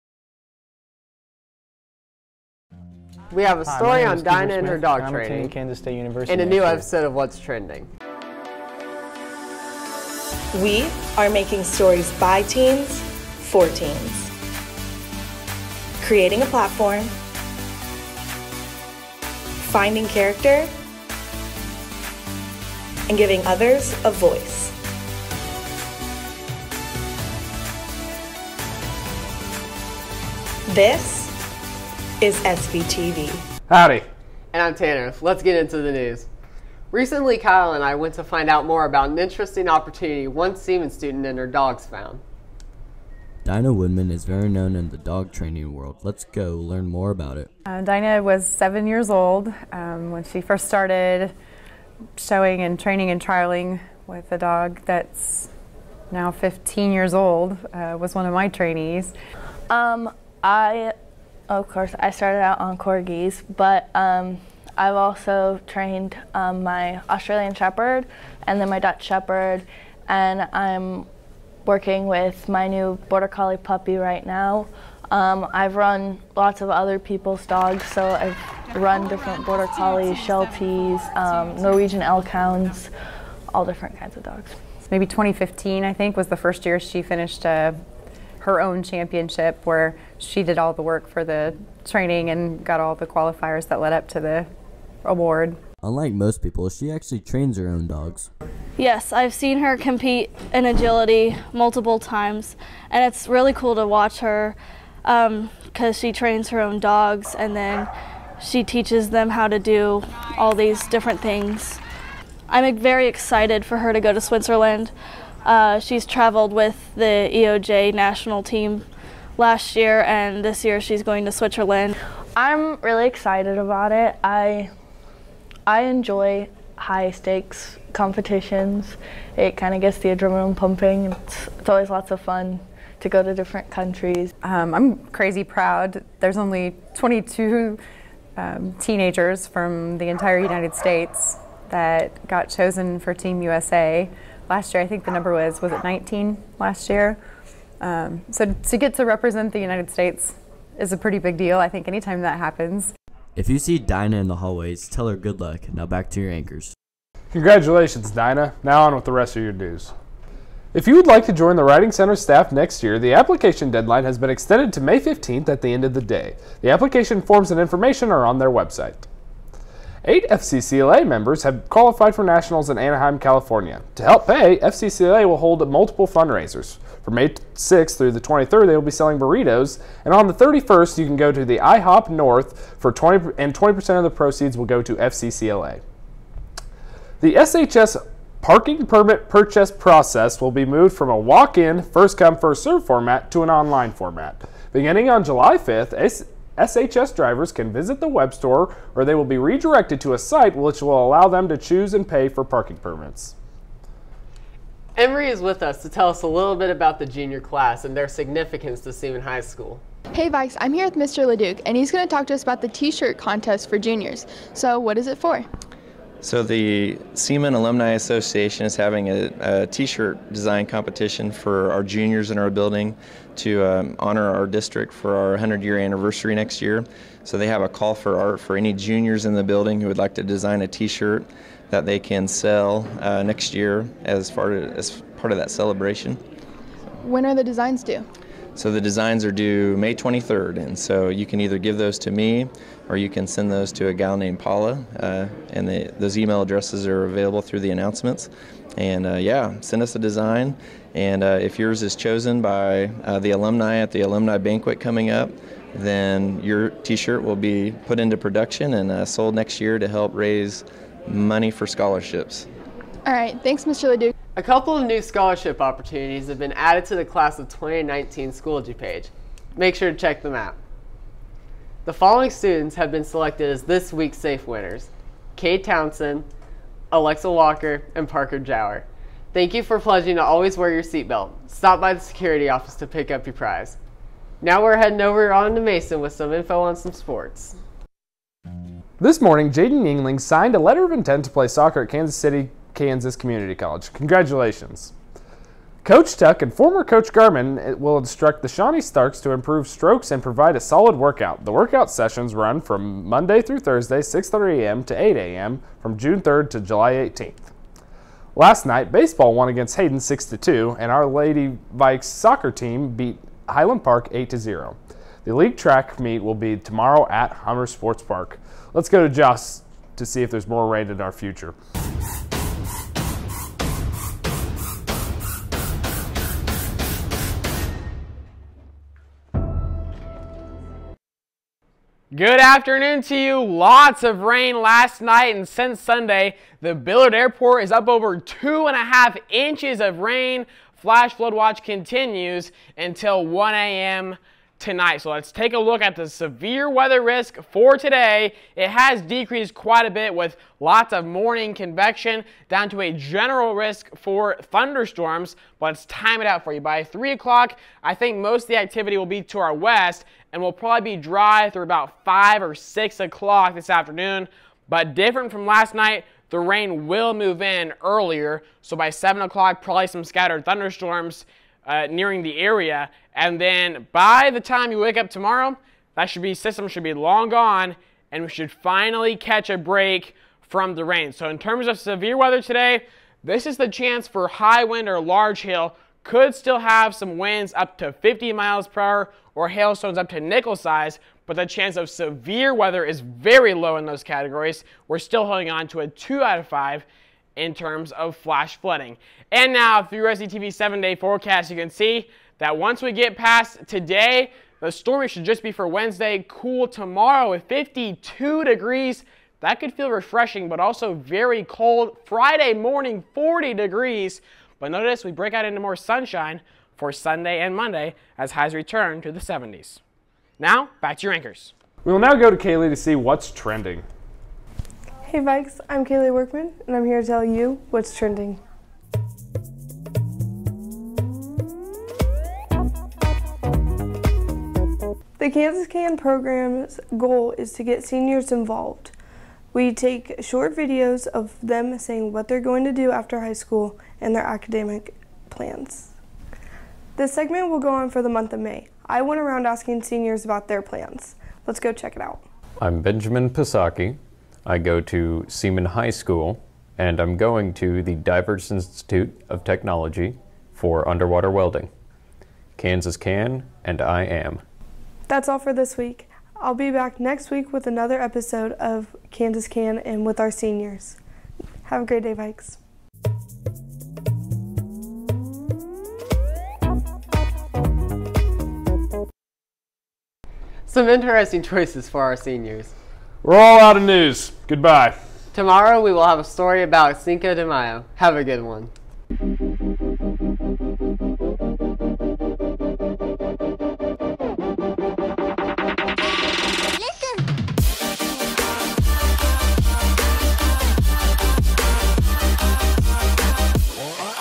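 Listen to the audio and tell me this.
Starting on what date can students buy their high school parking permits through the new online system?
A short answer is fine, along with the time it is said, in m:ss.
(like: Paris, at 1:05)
July 5th, at 3:15.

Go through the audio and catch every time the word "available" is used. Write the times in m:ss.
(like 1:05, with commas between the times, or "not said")
4:07.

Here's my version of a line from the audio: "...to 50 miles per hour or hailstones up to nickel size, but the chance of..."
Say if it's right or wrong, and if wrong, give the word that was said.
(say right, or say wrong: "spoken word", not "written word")
right.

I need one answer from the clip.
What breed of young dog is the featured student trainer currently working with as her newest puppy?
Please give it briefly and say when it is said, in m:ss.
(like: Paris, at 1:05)
Border Collie, at 1:13.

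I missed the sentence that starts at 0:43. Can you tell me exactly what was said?
Dyna Woodman is very known in the dog training world.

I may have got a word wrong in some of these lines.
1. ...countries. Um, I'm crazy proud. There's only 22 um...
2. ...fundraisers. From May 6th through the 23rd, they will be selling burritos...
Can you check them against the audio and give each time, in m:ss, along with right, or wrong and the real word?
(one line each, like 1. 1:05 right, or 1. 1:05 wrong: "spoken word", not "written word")
1. 2:13 right
2. 2:56 right.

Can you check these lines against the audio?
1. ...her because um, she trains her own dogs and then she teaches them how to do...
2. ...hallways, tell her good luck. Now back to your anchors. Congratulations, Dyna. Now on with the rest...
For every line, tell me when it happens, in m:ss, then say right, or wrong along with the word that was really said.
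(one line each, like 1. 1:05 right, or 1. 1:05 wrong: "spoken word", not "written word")
1. 1:44 right
2. 2:34 right.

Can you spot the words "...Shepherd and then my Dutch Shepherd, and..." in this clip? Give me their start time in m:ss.
1:07.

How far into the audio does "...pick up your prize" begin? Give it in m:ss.
4:42.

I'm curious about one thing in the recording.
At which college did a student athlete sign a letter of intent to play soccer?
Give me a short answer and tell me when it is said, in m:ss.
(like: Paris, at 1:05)
Kansas City Kansas Community College, at 4:51.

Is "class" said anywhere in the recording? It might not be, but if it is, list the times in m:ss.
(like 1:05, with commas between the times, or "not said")
3:27, 4:27.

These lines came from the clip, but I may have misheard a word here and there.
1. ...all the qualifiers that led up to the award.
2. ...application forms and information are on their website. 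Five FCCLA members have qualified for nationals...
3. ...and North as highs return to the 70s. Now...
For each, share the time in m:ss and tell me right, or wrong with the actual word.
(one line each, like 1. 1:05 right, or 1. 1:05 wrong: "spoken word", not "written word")
1. 1:32 right
2. 2:46 wrong: "Eight", not "Five"
3. 6:57 wrong: "Monday", not "North".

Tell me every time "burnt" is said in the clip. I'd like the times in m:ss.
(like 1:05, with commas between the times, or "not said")
not said.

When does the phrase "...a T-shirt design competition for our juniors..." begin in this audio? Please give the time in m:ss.
3:39.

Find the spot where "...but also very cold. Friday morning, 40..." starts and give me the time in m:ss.
6:50.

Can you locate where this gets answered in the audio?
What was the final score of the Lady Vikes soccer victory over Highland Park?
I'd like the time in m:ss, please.
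5:14.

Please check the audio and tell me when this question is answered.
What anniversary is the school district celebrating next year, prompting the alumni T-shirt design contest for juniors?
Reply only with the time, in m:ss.
3:45.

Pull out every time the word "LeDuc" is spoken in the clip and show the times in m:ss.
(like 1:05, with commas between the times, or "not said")
3:31, 4:23.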